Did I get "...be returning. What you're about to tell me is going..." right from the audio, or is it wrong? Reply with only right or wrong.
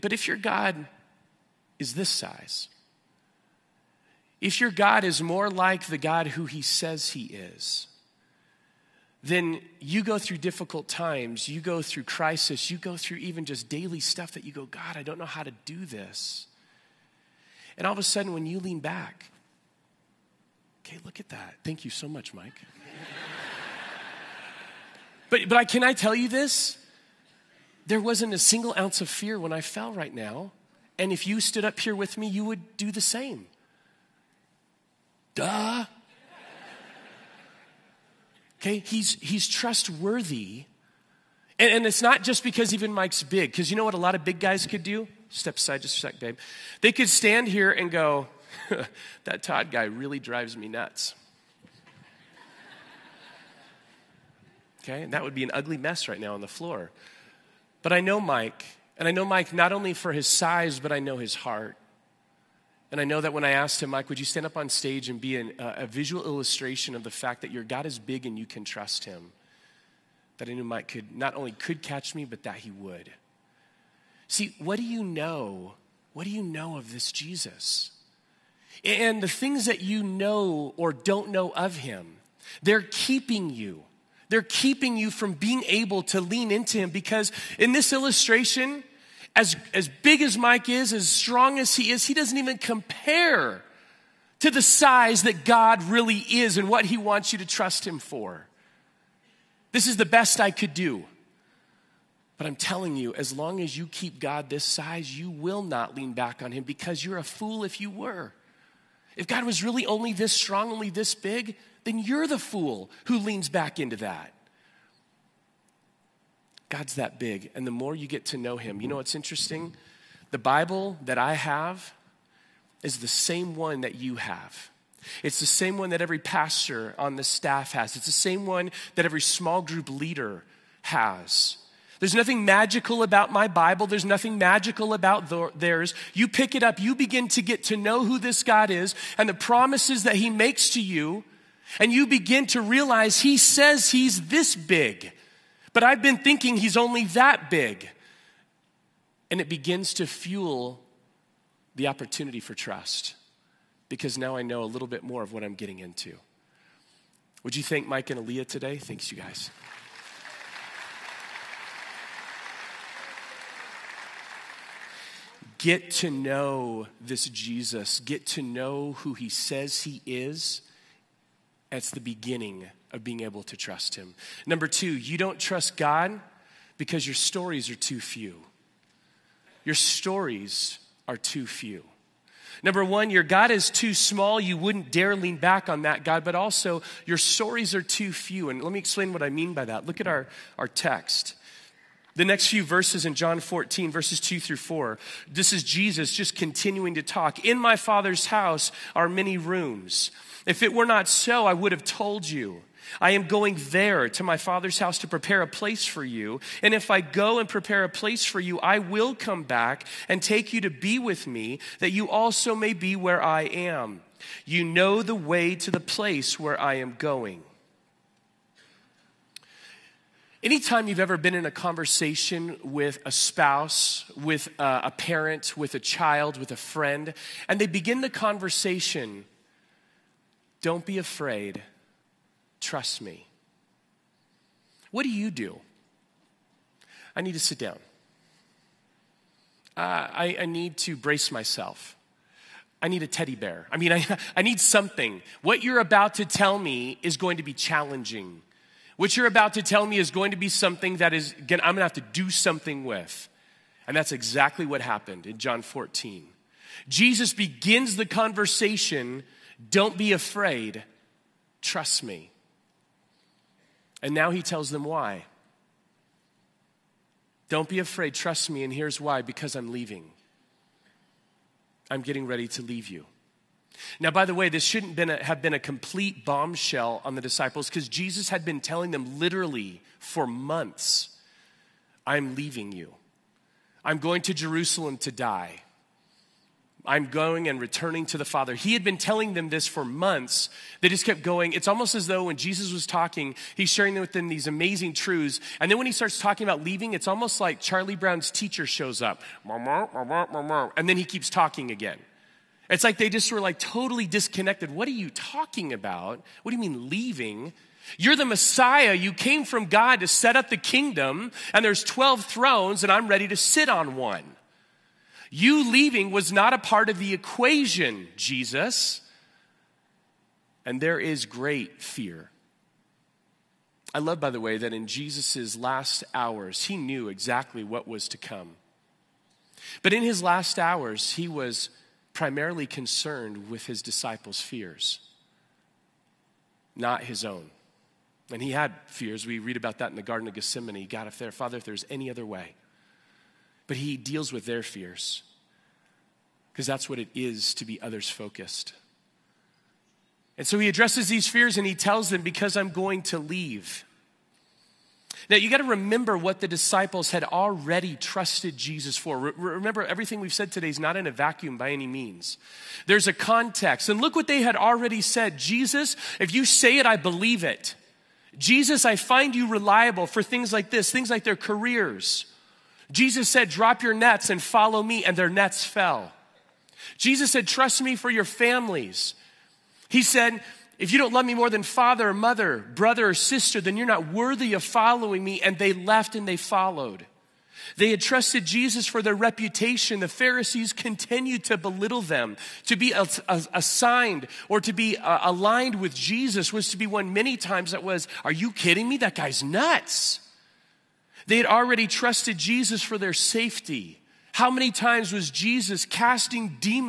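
wrong.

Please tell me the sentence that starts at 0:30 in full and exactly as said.
And if you stood up here with me, you would do the same.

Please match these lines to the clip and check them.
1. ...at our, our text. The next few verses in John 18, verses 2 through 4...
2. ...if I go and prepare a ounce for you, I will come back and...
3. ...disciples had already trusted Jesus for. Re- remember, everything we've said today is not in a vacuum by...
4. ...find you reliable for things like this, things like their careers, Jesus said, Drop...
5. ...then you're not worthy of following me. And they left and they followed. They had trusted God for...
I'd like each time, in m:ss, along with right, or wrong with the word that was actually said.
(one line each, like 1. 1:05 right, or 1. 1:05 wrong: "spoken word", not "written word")
1. 3:09 wrong: "14", not "18"
2. 3:26 wrong: "place", not "ounce"
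3. 5:56 right
4. 6:08 right
5. 6:23 wrong: "Jesus", not "God".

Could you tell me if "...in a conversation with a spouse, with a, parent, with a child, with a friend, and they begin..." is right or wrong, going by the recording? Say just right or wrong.
right.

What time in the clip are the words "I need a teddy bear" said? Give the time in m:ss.
4:02.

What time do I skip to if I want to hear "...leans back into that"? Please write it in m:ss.
1:53.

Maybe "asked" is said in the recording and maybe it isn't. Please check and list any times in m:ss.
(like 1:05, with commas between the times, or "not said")
1:03.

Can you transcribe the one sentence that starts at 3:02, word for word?
Number one, your God is too small.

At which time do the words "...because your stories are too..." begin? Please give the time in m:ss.
2:56.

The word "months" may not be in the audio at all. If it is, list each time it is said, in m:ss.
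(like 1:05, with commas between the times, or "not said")
4:40, 4:49.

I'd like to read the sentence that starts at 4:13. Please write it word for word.
And that's exactly what happened in John 14.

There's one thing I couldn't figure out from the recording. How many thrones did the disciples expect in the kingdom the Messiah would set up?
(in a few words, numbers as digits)
12.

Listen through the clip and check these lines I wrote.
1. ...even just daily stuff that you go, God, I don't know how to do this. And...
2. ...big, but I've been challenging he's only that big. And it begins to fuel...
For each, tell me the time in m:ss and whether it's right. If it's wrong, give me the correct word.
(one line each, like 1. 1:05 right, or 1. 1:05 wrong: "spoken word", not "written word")
1. 0:13 right
2. 2:24 wrong: "thinking", not "challenging".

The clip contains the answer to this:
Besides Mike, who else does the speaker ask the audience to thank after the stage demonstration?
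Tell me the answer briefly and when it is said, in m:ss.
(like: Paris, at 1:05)
Aaliyah, at 2:38.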